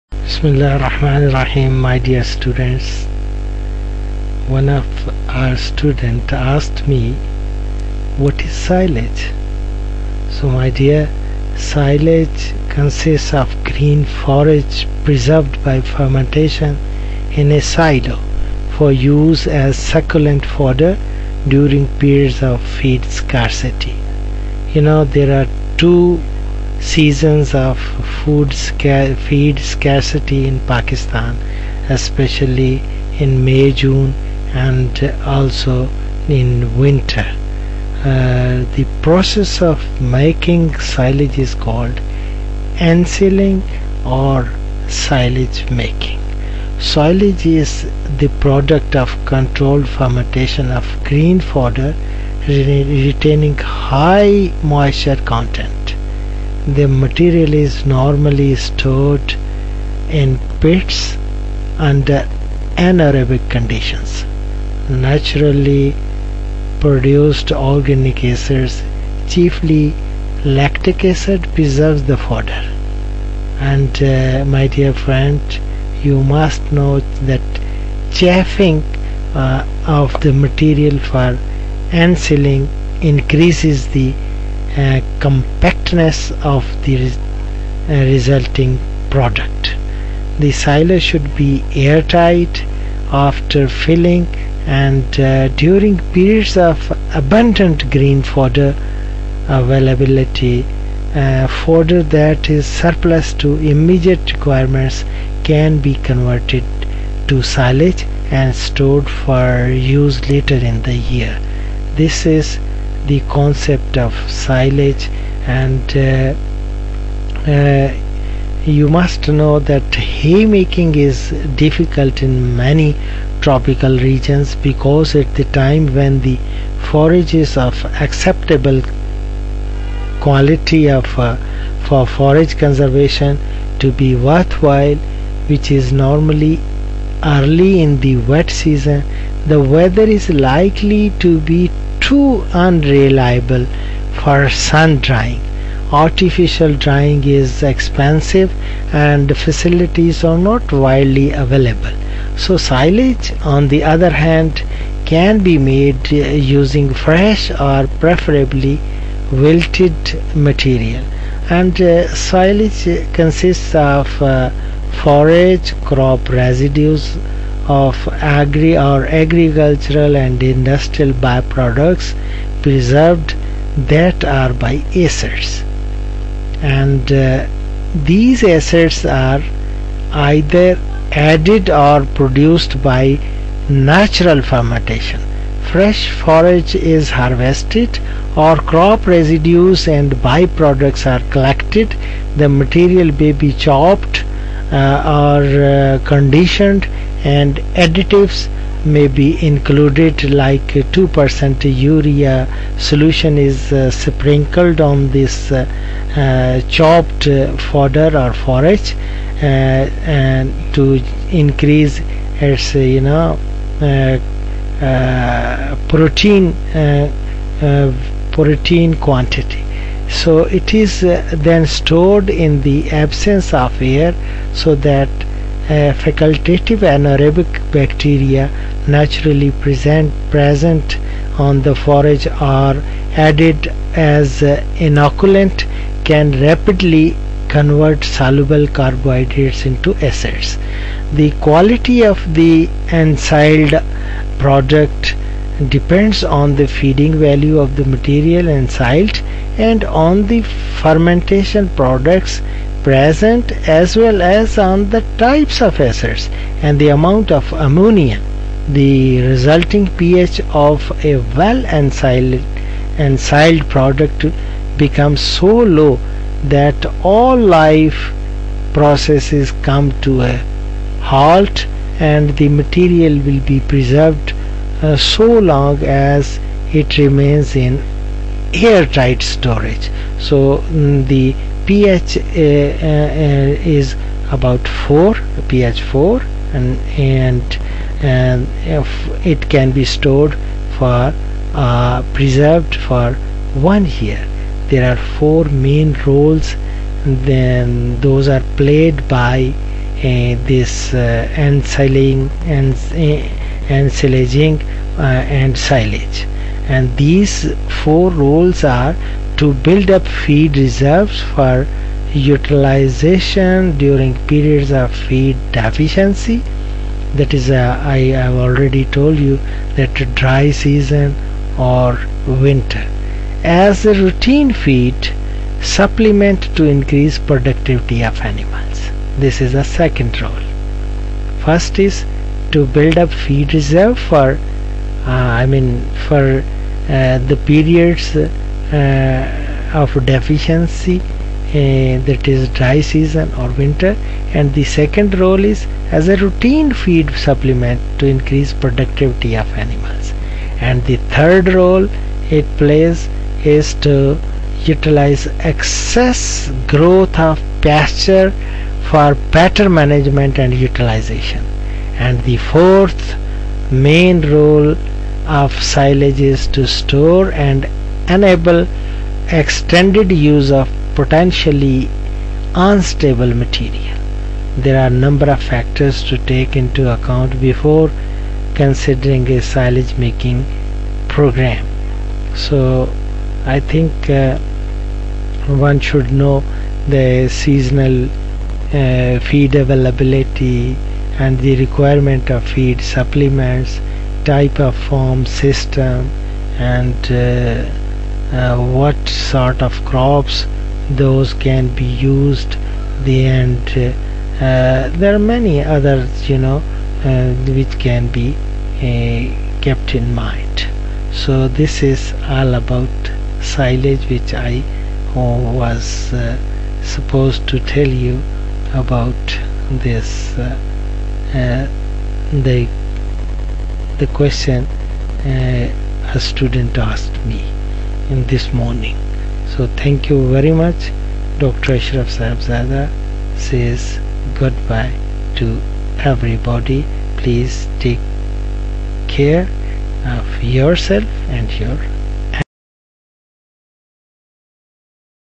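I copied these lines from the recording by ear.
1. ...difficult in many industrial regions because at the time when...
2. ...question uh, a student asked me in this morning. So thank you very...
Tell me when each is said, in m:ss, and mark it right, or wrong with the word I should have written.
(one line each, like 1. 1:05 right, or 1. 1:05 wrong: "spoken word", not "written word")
1. 2:01 wrong: "tropical", not "industrial"
2. 7:04 right.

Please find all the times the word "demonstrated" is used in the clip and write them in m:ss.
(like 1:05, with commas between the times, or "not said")
not said.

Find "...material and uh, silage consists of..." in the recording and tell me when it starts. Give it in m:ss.
2:40.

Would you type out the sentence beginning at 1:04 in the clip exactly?
Naturally produced organic acids, chiefly lactic acid, preserves the fodder.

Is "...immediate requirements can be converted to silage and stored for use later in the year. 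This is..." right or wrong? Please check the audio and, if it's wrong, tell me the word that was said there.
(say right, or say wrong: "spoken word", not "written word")
right.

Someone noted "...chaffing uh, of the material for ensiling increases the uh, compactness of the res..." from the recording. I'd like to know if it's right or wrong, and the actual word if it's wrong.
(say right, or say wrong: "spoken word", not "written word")
right.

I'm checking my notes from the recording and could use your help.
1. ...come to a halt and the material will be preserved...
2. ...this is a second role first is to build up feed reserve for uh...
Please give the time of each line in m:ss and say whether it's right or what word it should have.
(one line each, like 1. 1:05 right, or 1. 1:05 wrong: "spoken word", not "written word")
1. 4:29 right
2. 5:29 right.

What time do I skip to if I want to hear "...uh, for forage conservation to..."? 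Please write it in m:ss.
2:11.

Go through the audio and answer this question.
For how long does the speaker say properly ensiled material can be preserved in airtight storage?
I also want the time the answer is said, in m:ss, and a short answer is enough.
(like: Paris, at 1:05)
One year, at 4:53.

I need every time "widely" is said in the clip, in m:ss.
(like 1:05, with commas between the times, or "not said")
2:30.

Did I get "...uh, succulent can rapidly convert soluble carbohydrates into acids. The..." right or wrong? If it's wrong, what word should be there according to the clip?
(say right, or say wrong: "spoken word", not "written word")
wrong: "inoculant", not "succulent".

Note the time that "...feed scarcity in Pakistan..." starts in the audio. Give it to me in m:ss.
0:29.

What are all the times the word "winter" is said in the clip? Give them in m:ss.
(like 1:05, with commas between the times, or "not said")
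0:36, 5:22, 5:43.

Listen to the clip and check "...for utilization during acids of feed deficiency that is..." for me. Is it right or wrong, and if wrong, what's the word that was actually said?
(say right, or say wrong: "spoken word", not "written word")
wrong: "periods", not "acids".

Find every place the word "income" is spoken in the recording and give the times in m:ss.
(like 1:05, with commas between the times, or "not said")
not said.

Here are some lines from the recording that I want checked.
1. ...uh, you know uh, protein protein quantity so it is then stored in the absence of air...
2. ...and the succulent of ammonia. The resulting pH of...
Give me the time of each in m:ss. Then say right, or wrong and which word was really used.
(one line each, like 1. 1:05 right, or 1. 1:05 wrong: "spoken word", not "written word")
1. 3:32 right
2. 4:16 wrong: "amount", not "succulent".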